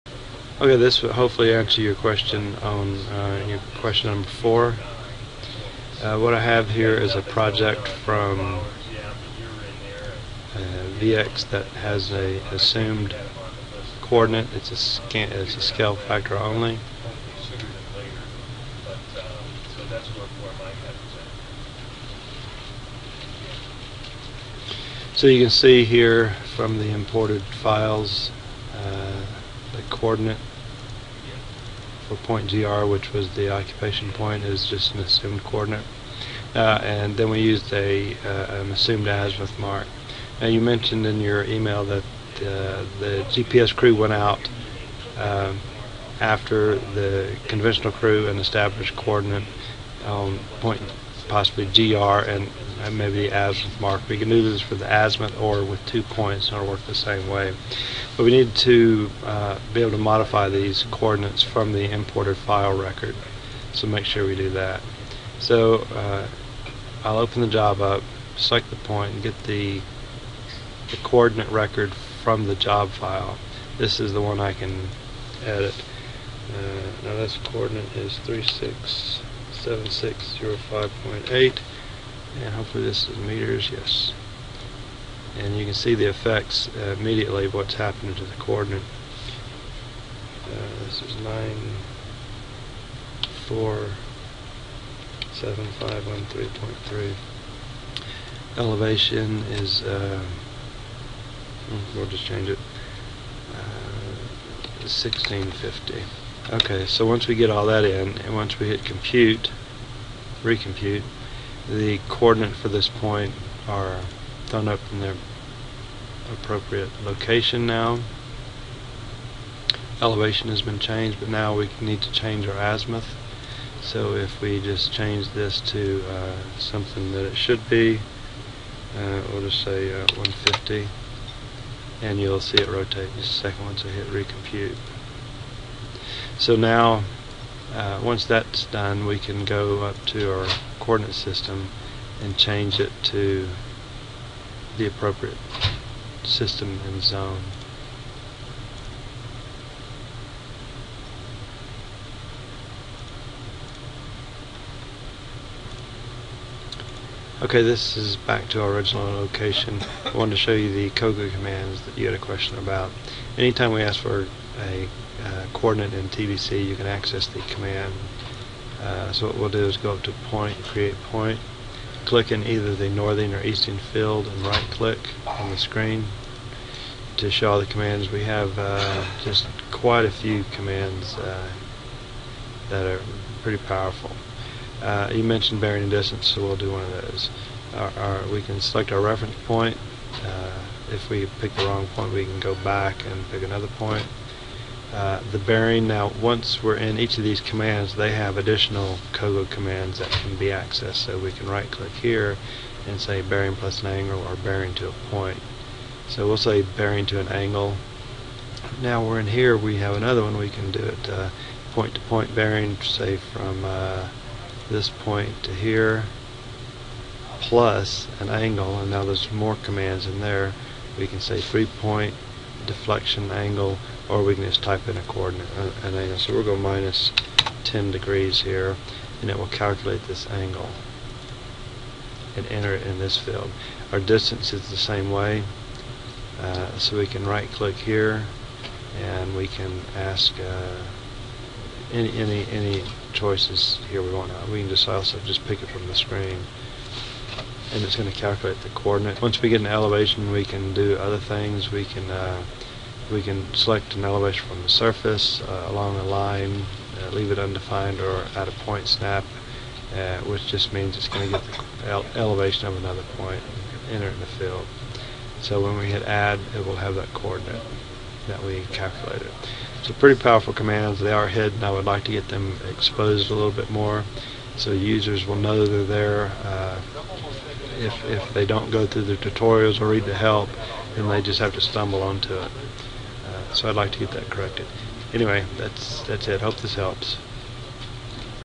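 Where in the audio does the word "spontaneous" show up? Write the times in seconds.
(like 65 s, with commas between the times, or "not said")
not said.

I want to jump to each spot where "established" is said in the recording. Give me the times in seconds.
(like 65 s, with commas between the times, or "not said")
48 s.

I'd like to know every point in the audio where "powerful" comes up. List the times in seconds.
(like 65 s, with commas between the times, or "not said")
183 s, 270 s.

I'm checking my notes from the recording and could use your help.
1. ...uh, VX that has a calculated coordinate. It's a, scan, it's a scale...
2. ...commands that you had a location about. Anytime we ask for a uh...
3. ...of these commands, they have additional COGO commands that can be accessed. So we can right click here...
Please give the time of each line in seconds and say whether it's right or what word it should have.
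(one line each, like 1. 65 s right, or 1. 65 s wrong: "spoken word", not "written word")
1. 10 s wrong: "assumed", not "calculated"
2. 161 s wrong: "question", not "location"
3. 197 s right.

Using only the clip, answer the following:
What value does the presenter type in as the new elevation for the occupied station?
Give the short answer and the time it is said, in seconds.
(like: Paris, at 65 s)
1650, at 104 s.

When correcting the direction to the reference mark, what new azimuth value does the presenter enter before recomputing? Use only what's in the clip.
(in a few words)
150.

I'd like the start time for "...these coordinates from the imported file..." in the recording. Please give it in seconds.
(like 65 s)
60 s.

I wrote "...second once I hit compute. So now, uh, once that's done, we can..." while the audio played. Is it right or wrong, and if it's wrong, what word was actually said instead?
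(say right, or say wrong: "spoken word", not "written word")
wrong: "recompute", not "compute".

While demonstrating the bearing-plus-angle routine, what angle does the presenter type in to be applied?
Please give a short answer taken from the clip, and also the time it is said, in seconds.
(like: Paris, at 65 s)
-10 degrees, at 226 s.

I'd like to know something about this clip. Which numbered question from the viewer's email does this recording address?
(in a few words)
4.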